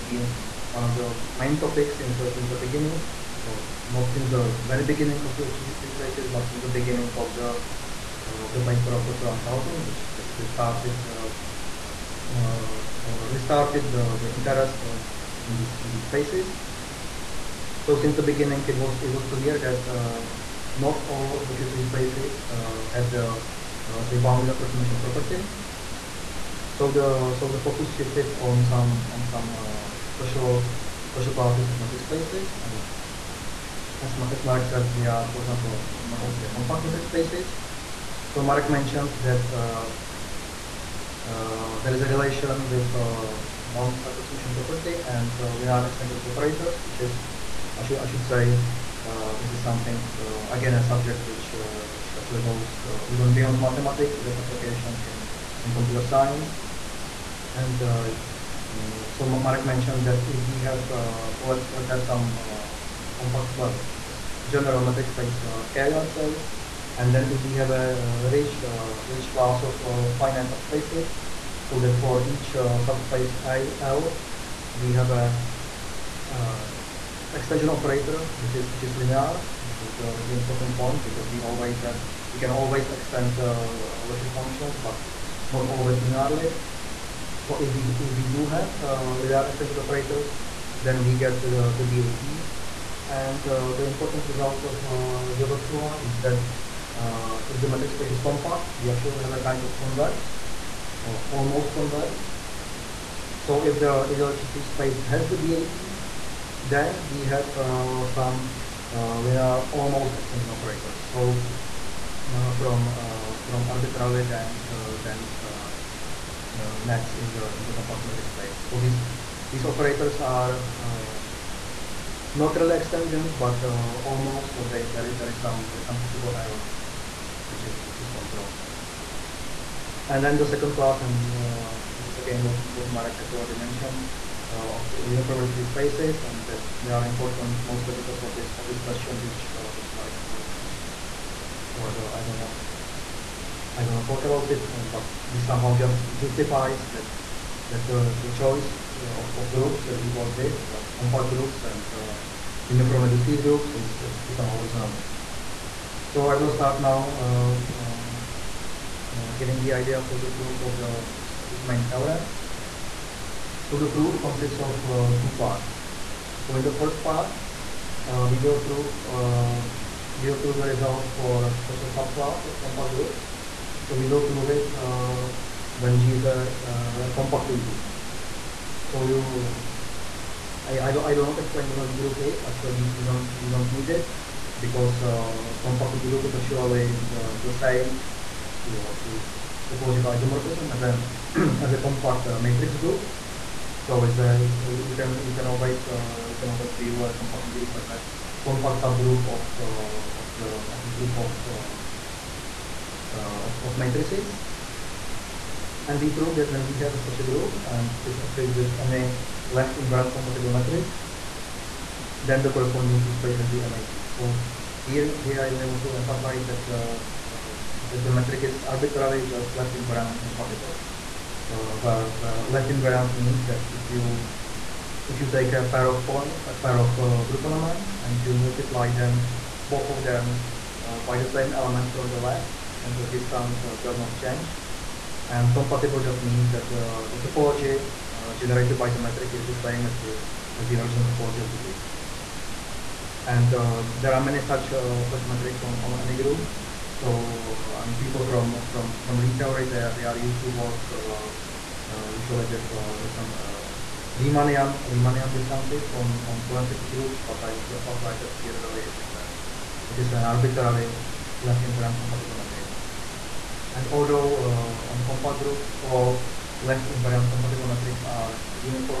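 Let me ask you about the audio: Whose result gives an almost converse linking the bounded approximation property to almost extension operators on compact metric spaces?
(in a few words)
Gilbert.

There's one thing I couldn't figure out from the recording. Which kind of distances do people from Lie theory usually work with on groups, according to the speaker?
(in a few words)
Riemannian distances.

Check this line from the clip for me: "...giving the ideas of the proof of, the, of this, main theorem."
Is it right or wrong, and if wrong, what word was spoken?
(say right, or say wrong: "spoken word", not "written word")
right.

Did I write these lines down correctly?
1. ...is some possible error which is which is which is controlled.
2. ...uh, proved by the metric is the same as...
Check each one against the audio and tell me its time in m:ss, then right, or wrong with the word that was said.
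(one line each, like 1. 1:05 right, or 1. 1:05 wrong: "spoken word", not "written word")
1. 2:05 right
2. 3:58 wrong: "generated", not "proved".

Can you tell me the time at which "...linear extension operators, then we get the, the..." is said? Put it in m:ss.
1:29.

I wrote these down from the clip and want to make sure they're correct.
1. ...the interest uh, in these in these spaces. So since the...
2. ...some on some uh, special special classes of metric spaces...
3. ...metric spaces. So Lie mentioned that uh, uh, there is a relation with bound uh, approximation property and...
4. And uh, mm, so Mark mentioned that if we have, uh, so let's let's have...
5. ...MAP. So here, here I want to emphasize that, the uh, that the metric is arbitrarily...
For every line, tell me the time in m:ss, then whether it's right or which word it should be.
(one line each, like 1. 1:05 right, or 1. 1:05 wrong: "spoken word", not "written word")
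1. 0:14 right
2. 0:28 right
3. 0:36 wrong: "Mark", not "Lie"
4. 0:57 right
5. 3:33 right.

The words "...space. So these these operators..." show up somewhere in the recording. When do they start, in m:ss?
1:58.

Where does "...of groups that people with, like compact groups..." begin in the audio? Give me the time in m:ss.
2:29.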